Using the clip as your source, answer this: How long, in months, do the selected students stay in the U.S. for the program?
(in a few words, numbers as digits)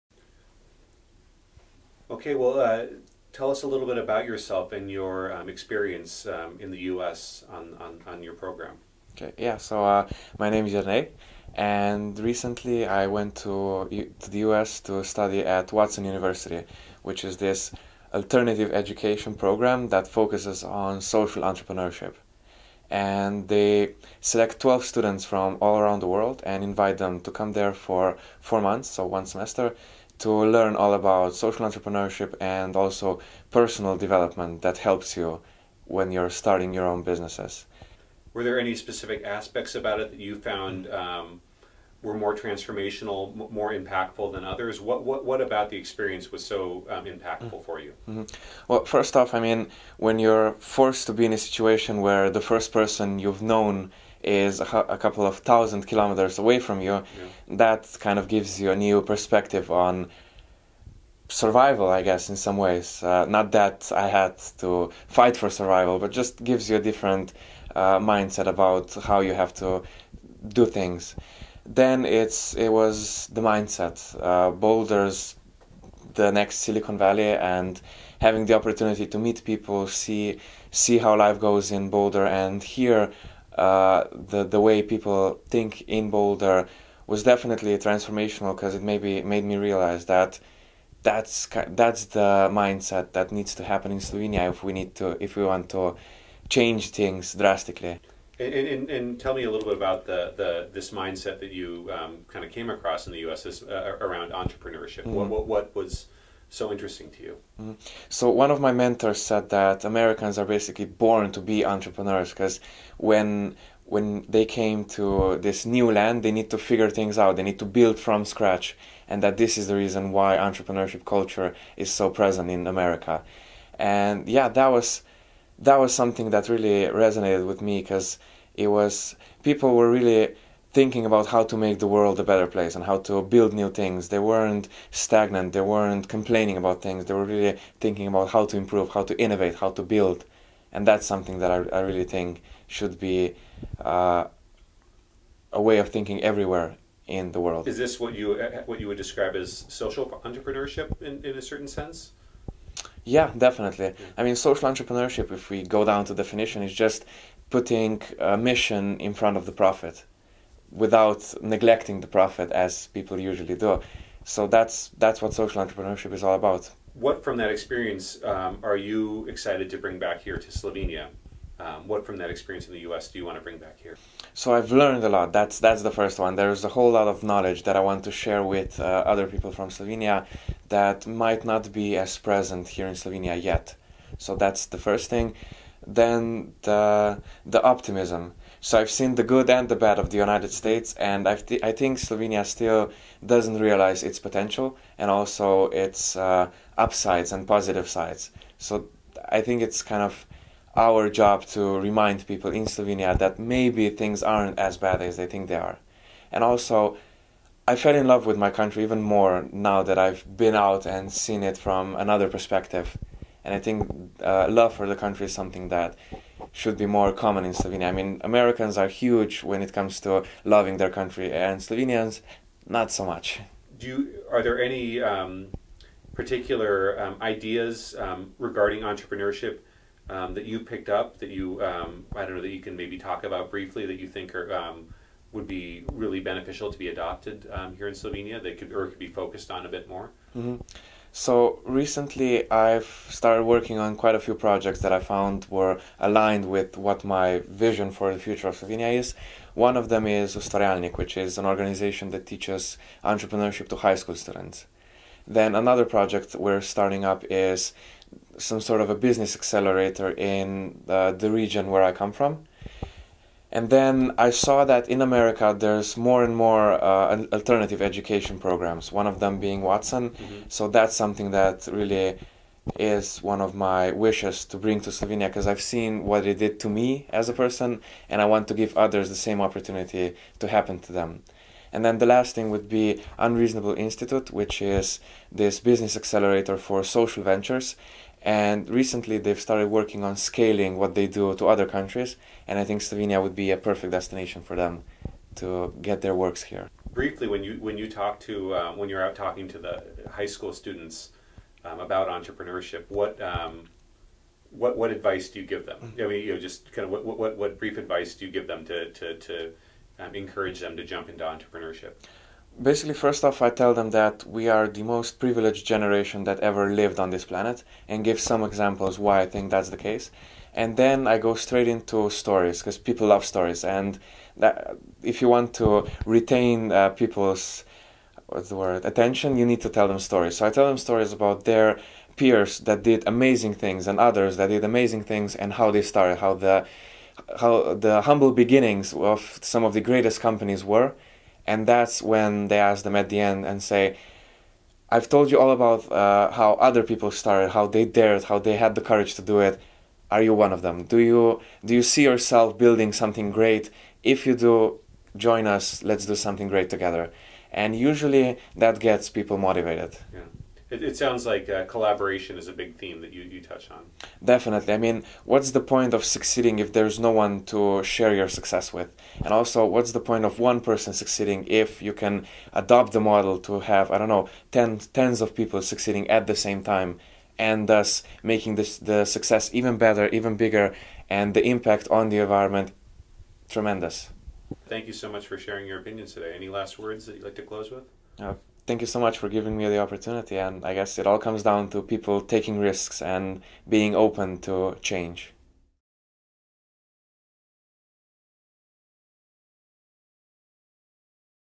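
4.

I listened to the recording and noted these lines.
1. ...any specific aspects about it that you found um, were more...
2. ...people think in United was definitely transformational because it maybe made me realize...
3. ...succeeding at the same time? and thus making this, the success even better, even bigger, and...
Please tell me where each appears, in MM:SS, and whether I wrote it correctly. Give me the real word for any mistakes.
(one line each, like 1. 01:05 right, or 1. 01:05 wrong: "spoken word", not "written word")
1. 00:38 right
2. 01:24 wrong: "Boulder", not "United"
3. 06:15 right.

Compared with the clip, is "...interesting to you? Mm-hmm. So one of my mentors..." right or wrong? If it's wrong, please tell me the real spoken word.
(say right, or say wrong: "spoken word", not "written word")
right.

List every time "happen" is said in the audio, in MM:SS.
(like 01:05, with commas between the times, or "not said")
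01:33, 04:40.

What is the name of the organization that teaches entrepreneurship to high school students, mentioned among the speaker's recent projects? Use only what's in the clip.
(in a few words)
Ustvarjalnik.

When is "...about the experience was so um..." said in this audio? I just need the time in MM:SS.
00:45.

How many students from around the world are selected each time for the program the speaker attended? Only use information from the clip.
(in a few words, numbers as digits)
12.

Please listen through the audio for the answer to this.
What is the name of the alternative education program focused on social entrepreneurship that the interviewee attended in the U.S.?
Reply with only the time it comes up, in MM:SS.
00:15.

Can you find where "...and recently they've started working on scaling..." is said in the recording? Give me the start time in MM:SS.
04:48.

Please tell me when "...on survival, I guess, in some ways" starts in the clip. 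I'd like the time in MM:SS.
00:59.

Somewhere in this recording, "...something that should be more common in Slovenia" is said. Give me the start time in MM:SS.
03:35.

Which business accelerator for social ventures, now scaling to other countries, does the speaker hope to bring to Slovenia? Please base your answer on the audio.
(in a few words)
Unreasonable Institute.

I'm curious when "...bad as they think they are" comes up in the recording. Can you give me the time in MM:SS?
03:24.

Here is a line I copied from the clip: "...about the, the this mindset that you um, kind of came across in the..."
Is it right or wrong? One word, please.
right.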